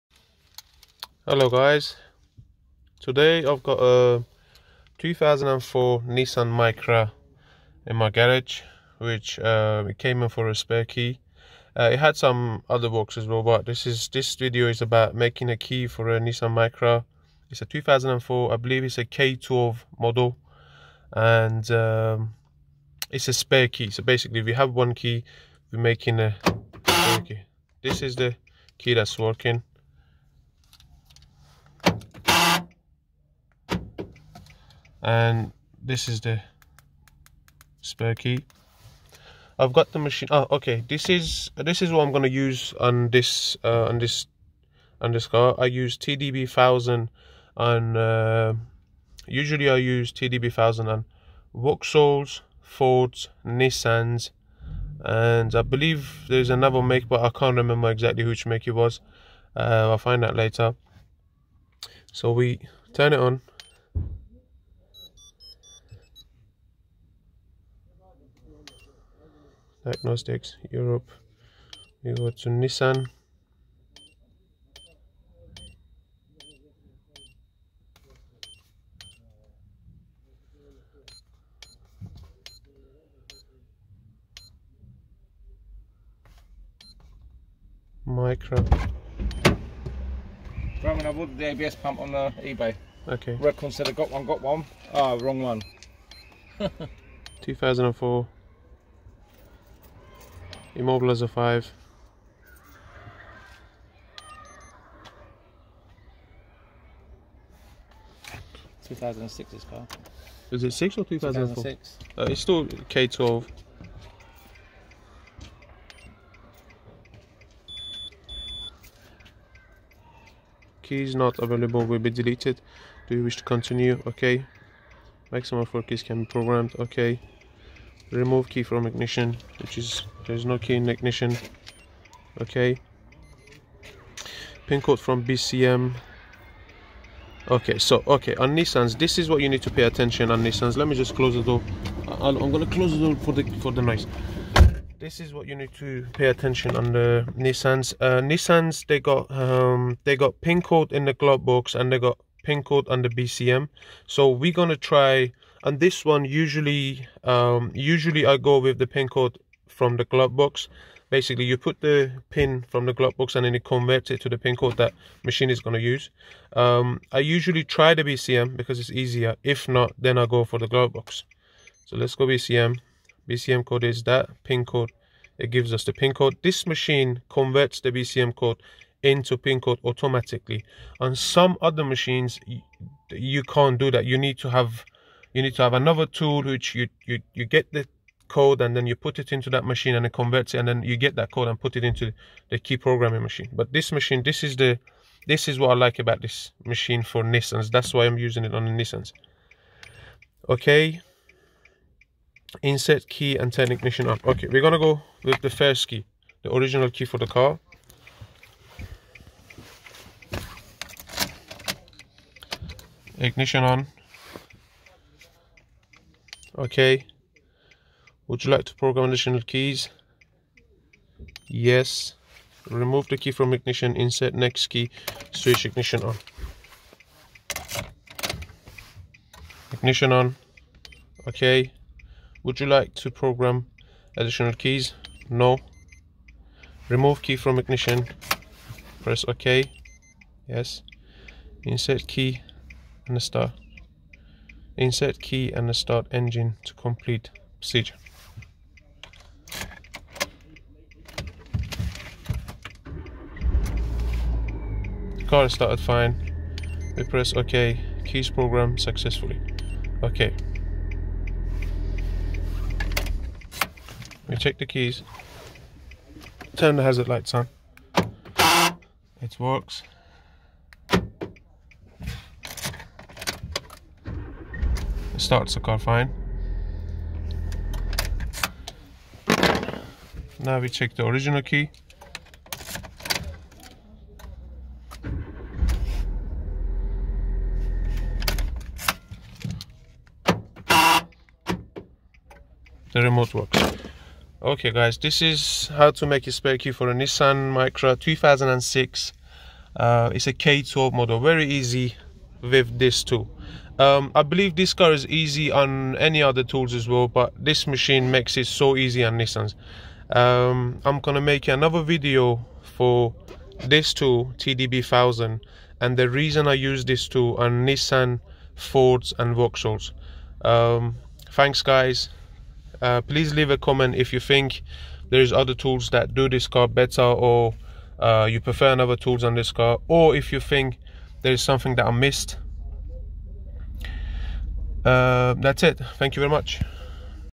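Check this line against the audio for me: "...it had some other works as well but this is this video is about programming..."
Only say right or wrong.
wrong.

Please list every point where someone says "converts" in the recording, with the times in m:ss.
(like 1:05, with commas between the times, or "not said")
2:43, 2:57, 3:10.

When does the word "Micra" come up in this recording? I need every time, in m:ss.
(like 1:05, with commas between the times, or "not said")
0:06, 0:16, 1:28, 4:57.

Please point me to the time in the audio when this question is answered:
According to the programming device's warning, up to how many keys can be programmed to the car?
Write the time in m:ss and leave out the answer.
2:05.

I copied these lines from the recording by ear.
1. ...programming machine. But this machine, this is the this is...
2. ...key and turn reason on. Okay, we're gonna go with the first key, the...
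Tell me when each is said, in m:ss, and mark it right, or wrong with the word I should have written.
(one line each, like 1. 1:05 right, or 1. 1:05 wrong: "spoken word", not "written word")
1. 3:12 right
2. 3:23 wrong: "ignition", not "reason".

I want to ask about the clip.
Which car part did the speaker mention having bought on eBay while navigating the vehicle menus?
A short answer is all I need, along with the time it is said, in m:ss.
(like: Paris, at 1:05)
ABS pump, at 1:31.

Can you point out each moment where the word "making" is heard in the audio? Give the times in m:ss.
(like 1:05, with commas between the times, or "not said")
0:15, 0:25.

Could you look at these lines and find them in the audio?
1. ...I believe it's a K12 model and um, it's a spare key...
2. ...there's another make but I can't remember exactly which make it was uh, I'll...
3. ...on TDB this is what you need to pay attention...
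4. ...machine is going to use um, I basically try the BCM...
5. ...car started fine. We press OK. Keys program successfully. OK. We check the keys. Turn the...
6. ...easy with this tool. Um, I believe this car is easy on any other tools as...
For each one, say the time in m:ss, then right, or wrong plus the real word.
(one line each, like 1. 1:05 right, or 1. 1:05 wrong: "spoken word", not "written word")
1. 0:18 right
2. 0:56 right
3. 2:18 wrong: "Nissans", not "TDB"
4. 2:45 wrong: "usually", not "basically"
5. 4:15 right
6. 5:01 right.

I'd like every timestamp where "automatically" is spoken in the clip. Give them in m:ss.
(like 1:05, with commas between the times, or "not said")
2:59.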